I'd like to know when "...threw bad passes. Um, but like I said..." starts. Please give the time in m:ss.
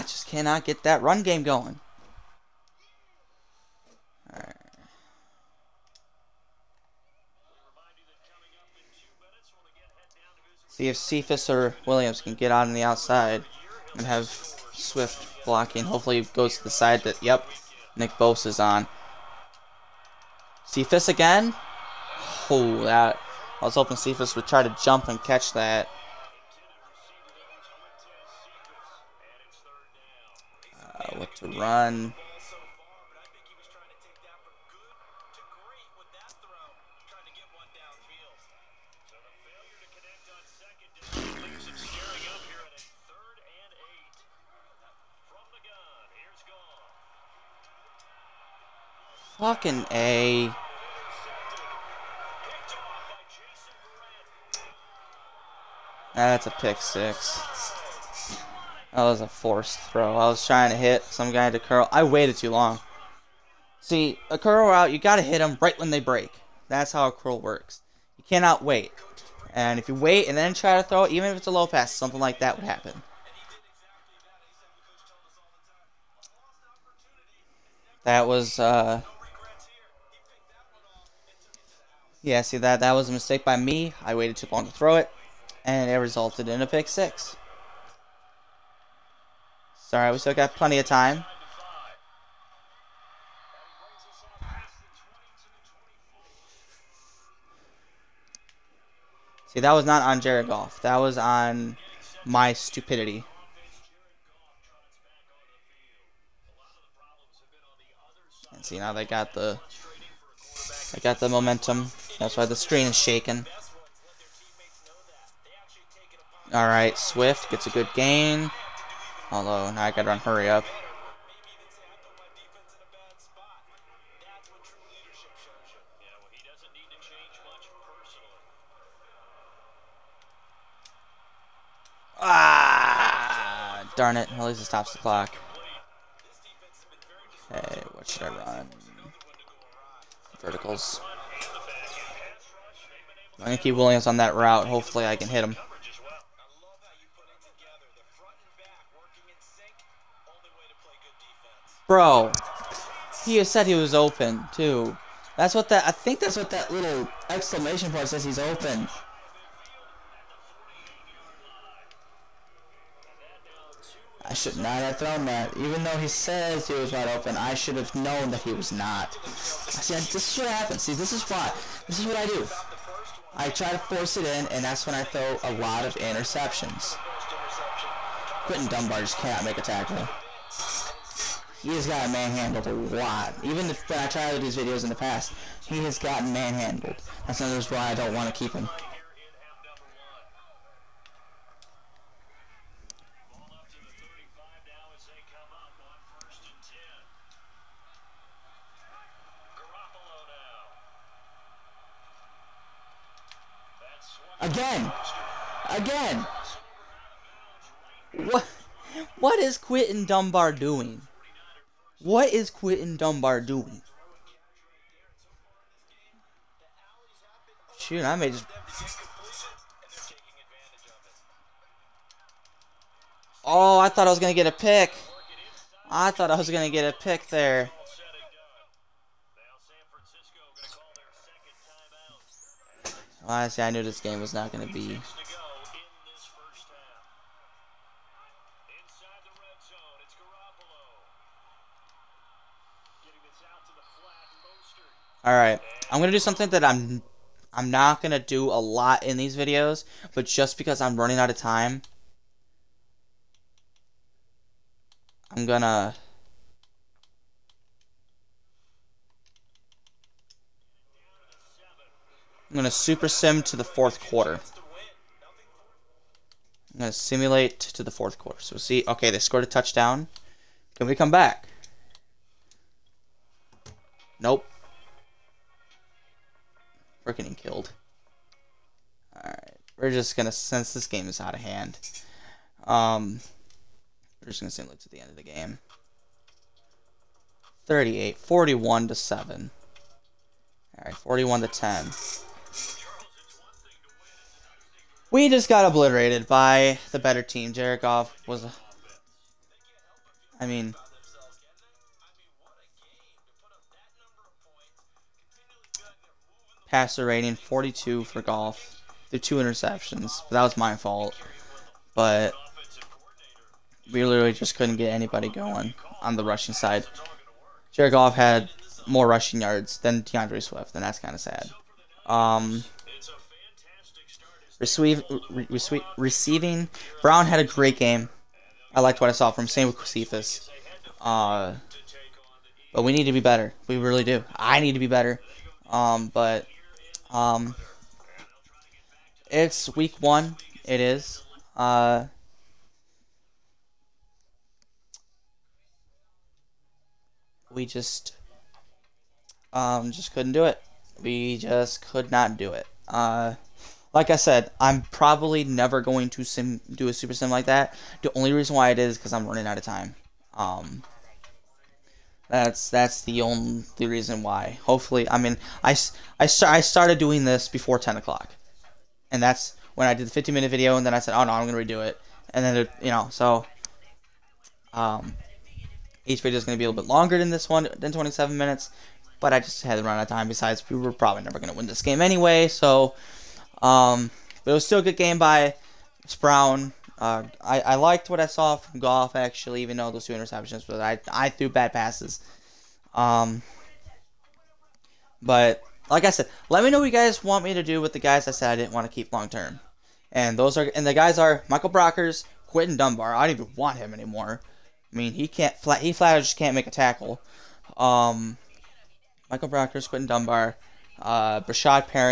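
6:31.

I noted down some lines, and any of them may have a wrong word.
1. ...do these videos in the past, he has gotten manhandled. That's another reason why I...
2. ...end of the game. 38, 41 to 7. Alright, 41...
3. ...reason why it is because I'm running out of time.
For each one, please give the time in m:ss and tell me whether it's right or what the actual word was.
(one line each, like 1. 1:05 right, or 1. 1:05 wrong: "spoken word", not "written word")
1. 3:04 right
2. 4:44 right
3. 5:58 right.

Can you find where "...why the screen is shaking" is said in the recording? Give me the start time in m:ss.
1:52.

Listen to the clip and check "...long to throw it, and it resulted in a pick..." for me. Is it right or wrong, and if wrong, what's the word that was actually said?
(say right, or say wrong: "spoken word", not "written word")
right.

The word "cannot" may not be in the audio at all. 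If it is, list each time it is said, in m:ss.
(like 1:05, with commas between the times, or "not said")
0:00, 1:08, 2:59.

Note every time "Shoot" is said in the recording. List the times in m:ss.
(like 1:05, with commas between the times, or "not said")
3:37.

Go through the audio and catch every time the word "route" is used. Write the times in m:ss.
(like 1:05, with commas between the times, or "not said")
1:04, 2:24.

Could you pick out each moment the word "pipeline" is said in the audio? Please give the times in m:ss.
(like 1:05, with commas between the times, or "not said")
not said.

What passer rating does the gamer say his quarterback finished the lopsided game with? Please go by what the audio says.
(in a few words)
42.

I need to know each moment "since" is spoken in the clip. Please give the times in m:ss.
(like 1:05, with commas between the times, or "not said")
4:40.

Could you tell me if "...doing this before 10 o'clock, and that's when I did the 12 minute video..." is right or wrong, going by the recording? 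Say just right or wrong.
wrong.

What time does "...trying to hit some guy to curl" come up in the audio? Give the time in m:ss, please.
1:00.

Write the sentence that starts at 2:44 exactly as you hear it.
I should not have thrown that.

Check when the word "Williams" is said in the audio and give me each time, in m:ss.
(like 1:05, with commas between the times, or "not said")
0:11, 2:23.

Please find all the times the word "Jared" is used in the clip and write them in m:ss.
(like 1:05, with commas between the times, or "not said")
1:40, 5:17.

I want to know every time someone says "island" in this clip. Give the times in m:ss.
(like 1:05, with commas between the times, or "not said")
not said.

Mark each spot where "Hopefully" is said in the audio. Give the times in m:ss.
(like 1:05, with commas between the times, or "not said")
0:15, 2:24, 6:04.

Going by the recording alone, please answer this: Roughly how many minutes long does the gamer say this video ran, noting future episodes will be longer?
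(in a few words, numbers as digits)
27.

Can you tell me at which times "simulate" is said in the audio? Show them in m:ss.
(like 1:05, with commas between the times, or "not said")
4:26, 4:44.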